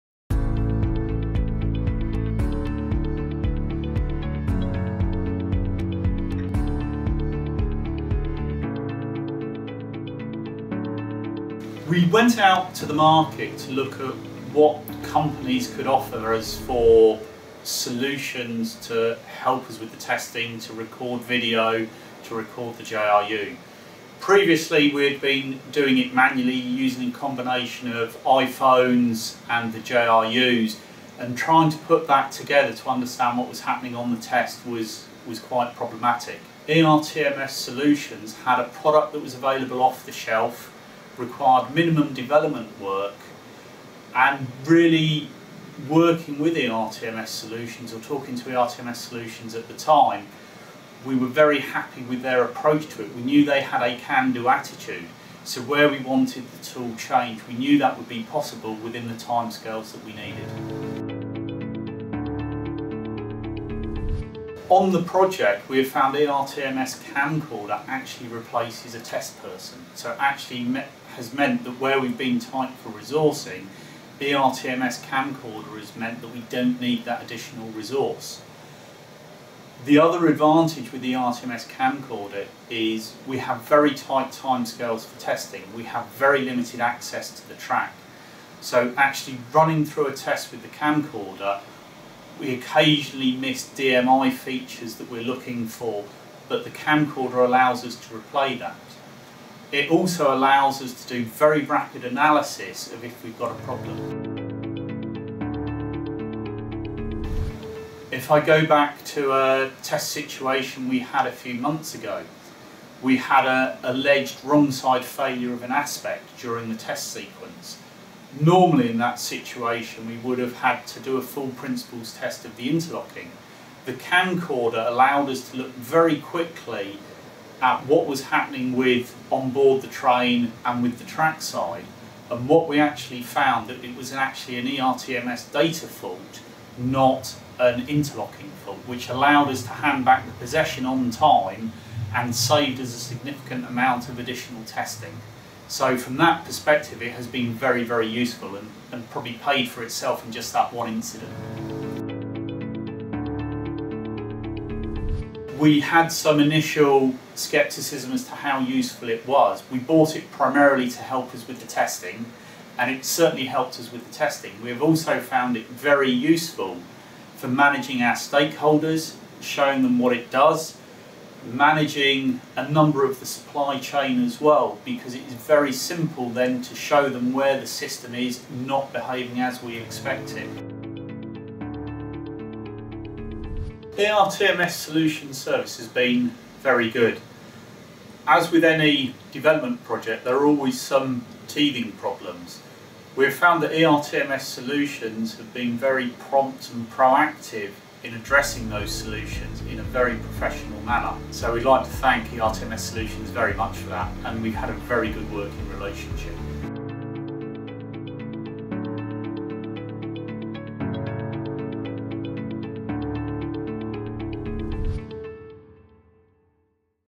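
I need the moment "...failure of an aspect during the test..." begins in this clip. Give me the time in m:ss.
1:55.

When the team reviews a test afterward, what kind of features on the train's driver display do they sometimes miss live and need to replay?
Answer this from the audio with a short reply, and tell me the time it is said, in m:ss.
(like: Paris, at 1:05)
DMI features, at 1:33.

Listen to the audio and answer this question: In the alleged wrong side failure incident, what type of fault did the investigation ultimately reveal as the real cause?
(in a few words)
ERTMS data fault.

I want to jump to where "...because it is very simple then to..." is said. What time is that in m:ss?
2:54.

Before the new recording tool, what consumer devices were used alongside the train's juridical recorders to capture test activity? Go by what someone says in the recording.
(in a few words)
iPhones.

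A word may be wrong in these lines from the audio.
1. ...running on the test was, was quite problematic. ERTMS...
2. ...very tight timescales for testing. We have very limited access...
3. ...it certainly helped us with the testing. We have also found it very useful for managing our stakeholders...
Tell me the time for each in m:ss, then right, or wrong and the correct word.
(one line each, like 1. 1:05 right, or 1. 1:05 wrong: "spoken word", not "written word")
1. 0:33 wrong: "happening", not "running"
2. 1:23 right
3. 2:42 right.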